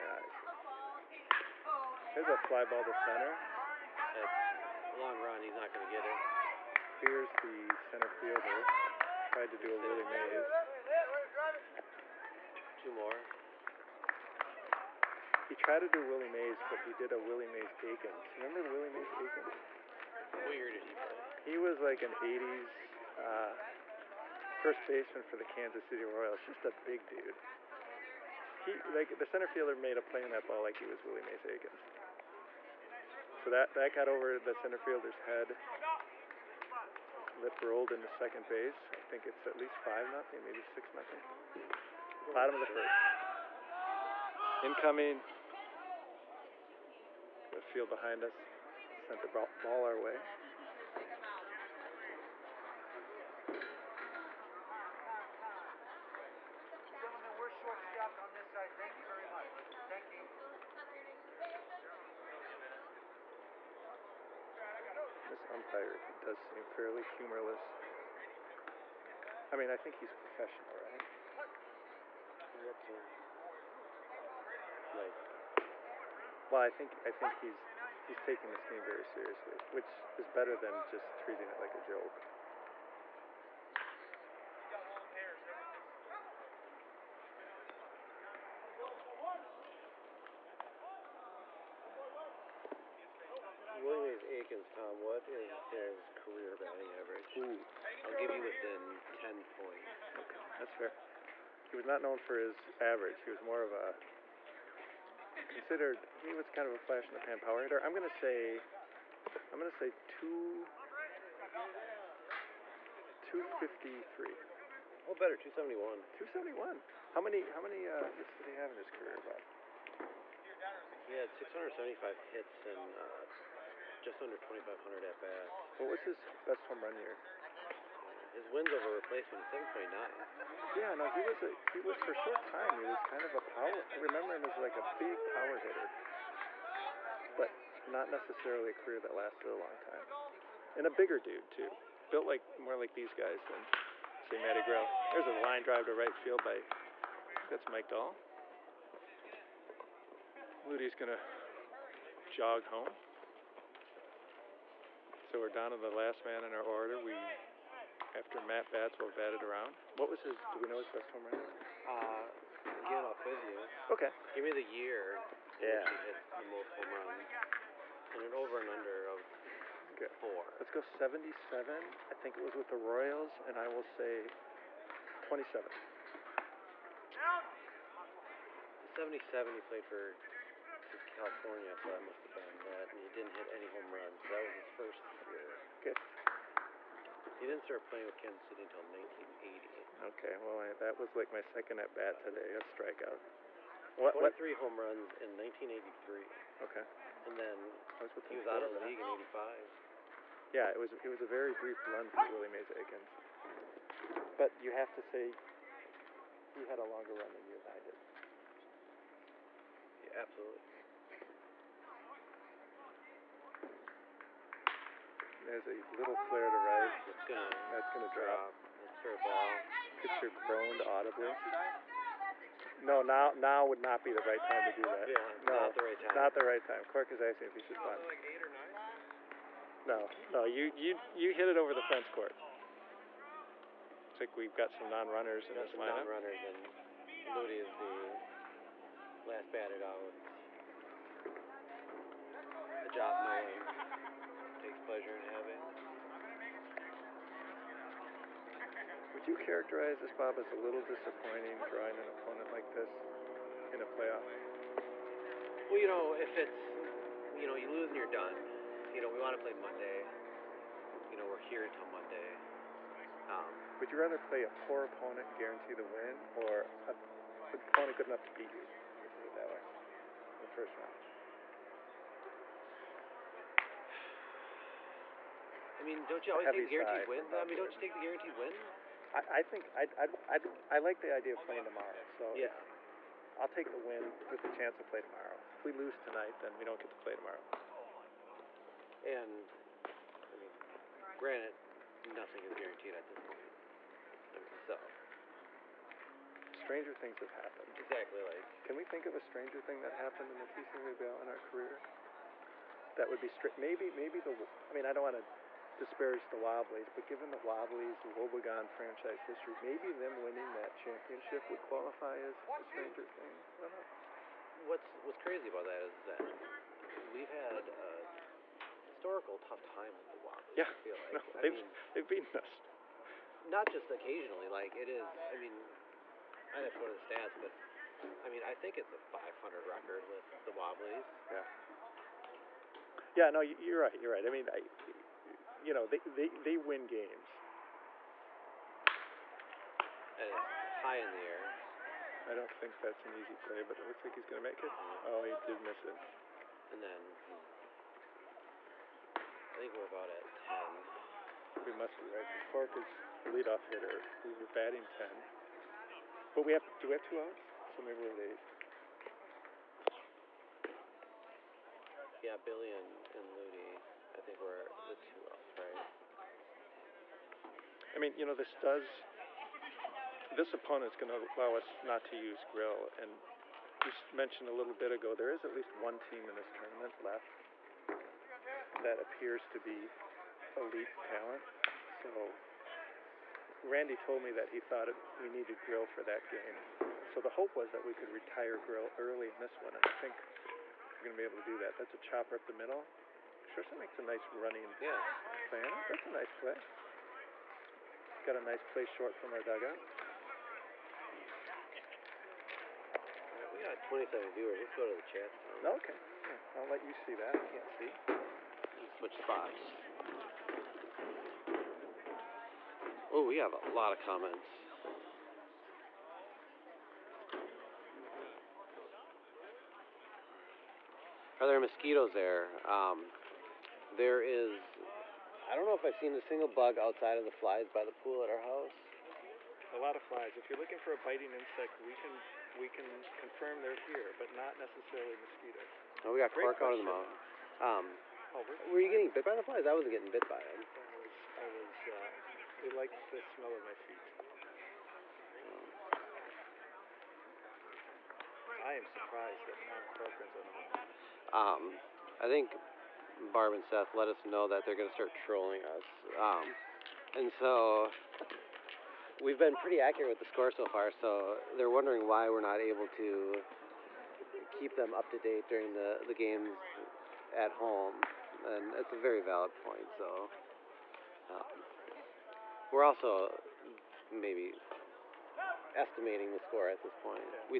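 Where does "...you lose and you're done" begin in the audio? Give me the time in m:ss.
4:17.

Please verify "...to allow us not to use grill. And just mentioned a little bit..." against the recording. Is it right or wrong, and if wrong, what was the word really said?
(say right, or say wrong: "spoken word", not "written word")
right.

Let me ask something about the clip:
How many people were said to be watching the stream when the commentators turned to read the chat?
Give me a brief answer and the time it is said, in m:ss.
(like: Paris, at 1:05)
27, at 6:43.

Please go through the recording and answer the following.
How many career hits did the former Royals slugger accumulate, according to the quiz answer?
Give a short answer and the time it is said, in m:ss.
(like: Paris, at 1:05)
675, at 2:01.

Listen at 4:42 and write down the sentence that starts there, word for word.
So If, I'll take the win with the chance to play tomorrow.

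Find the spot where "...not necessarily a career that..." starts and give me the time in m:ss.
2:17.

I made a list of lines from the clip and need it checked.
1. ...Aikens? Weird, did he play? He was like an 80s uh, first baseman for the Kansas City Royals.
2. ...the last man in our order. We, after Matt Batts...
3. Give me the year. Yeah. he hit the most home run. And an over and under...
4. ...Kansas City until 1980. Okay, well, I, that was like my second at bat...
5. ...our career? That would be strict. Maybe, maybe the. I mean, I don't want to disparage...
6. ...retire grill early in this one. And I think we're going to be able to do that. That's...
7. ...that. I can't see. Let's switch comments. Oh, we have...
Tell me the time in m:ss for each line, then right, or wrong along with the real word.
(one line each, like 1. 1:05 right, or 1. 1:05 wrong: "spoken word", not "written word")
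1. 0:19 right
2. 2:35 right
3. 2:44 right
4. 3:08 right
5. 5:01 right
6. 6:28 right
7. 6:47 wrong: "spots", not "comments".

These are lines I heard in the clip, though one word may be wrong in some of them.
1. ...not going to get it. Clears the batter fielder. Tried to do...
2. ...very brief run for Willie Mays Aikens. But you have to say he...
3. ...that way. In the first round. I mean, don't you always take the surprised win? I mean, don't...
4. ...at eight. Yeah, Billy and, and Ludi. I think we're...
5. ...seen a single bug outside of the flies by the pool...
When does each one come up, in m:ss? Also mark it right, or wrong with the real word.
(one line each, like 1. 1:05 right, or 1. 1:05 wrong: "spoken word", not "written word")
1. 0:05 wrong: "center", not "batter"
2. 3:21 right
3. 4:29 wrong: "guaranteed", not "surprised"
4. 5:58 right
5. 7:05 right.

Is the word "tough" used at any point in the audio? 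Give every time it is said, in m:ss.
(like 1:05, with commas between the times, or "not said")
5:19.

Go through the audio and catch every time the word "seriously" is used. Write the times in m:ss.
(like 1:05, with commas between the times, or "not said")
1:19.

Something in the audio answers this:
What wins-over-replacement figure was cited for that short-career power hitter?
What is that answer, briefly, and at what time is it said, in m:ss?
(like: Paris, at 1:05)
7.9, at 2:09.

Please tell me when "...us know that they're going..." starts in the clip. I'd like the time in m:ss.
7:34.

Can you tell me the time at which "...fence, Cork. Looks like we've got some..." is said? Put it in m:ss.
3:51.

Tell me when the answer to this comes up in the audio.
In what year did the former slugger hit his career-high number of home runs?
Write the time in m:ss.
3:15.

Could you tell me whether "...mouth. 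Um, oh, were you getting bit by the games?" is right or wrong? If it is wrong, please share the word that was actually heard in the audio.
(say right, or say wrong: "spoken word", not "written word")
wrong: "flies", not "games".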